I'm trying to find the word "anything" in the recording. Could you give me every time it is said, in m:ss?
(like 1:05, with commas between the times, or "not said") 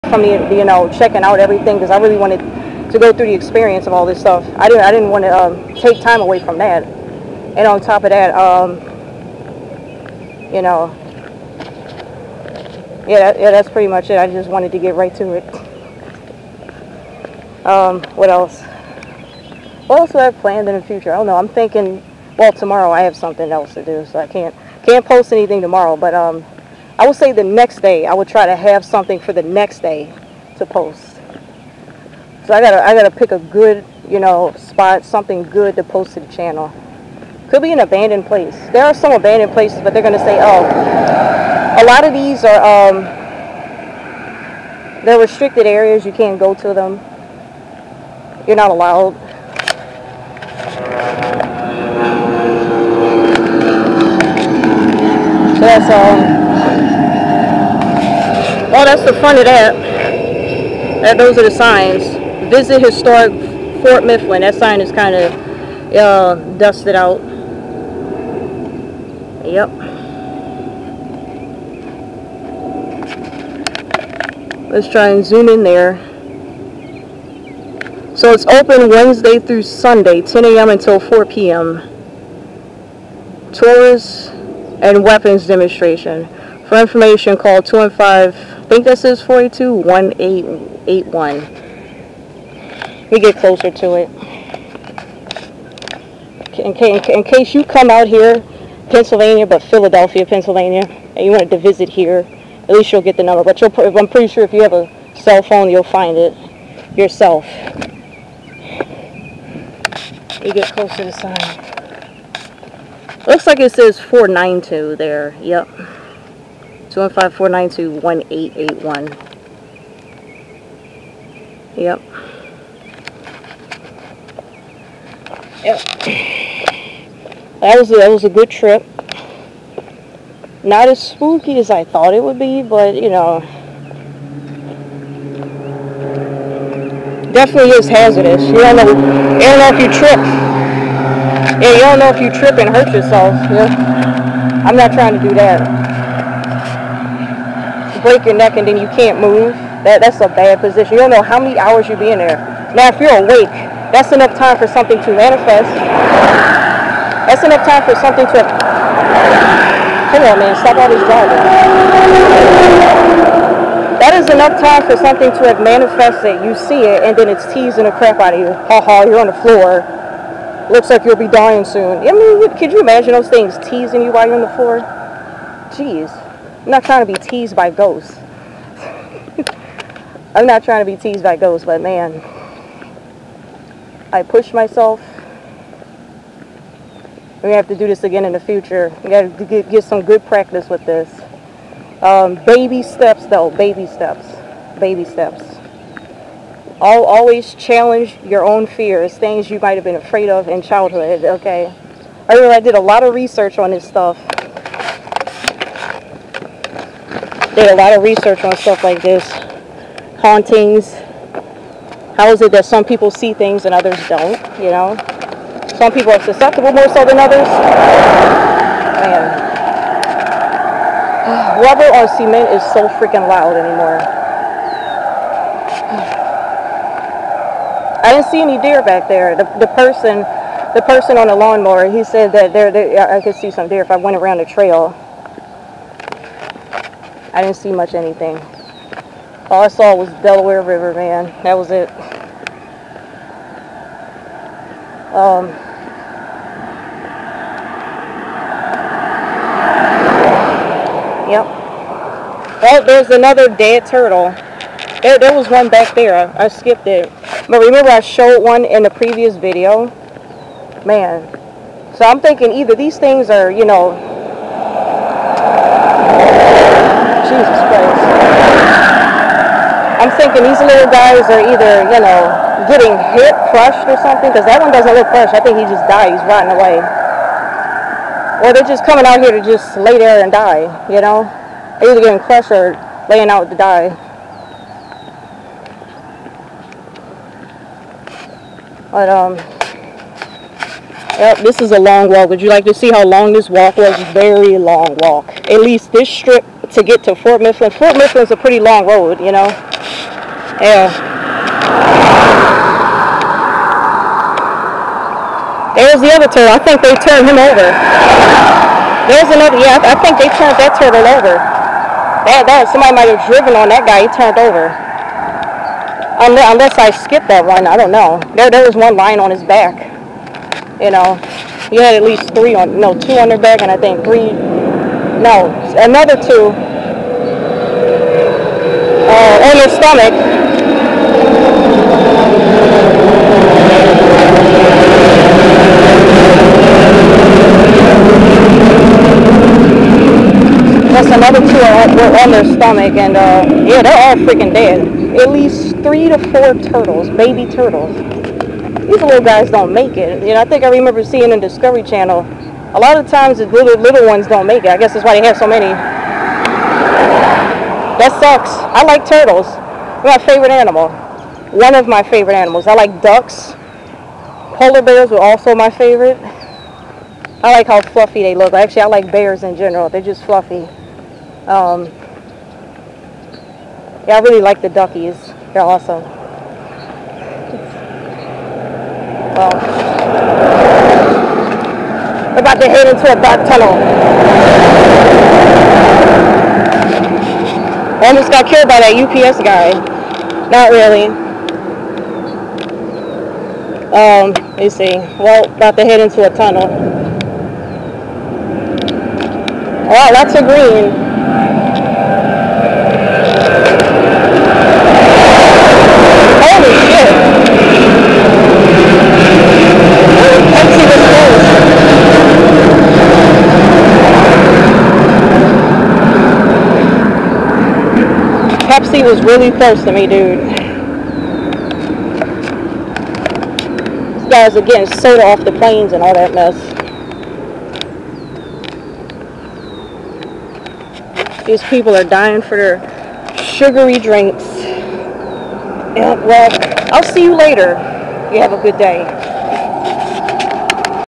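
0:25, 3:57.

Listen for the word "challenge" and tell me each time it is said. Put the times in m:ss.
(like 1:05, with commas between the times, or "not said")
3:17.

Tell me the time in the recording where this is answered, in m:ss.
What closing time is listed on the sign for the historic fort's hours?
1:20.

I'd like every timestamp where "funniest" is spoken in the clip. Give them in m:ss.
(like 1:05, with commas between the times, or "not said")
not said.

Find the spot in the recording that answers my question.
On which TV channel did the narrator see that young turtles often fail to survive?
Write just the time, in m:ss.
5:51.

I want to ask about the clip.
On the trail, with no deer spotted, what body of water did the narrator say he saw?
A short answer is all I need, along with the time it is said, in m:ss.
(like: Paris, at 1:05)
Delaware River, at 4:00.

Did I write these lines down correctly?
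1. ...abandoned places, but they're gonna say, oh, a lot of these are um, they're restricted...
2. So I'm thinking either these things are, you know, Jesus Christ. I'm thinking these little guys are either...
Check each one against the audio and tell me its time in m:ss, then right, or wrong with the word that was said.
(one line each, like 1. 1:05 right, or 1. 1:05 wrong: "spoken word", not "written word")
1. 0:39 right
2. 4:21 right.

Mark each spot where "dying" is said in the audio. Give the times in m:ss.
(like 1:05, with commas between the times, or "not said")
2:51, 7:12.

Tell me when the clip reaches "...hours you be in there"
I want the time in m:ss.
2:31.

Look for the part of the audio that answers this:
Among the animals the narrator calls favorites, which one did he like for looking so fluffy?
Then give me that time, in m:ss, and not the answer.
6:04.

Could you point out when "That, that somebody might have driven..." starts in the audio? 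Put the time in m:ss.
5:12.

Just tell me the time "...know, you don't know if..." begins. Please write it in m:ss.
2:18.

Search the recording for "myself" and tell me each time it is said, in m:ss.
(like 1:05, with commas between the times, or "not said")
3:04.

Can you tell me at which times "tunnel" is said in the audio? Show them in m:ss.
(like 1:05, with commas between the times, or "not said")
6:23, 6:36.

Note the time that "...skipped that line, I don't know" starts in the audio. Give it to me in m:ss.
5:16.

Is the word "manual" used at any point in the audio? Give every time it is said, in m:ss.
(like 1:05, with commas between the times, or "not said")
not said.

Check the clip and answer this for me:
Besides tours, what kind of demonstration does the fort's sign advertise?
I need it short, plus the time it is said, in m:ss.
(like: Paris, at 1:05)
Weapons demonstration, at 1:25.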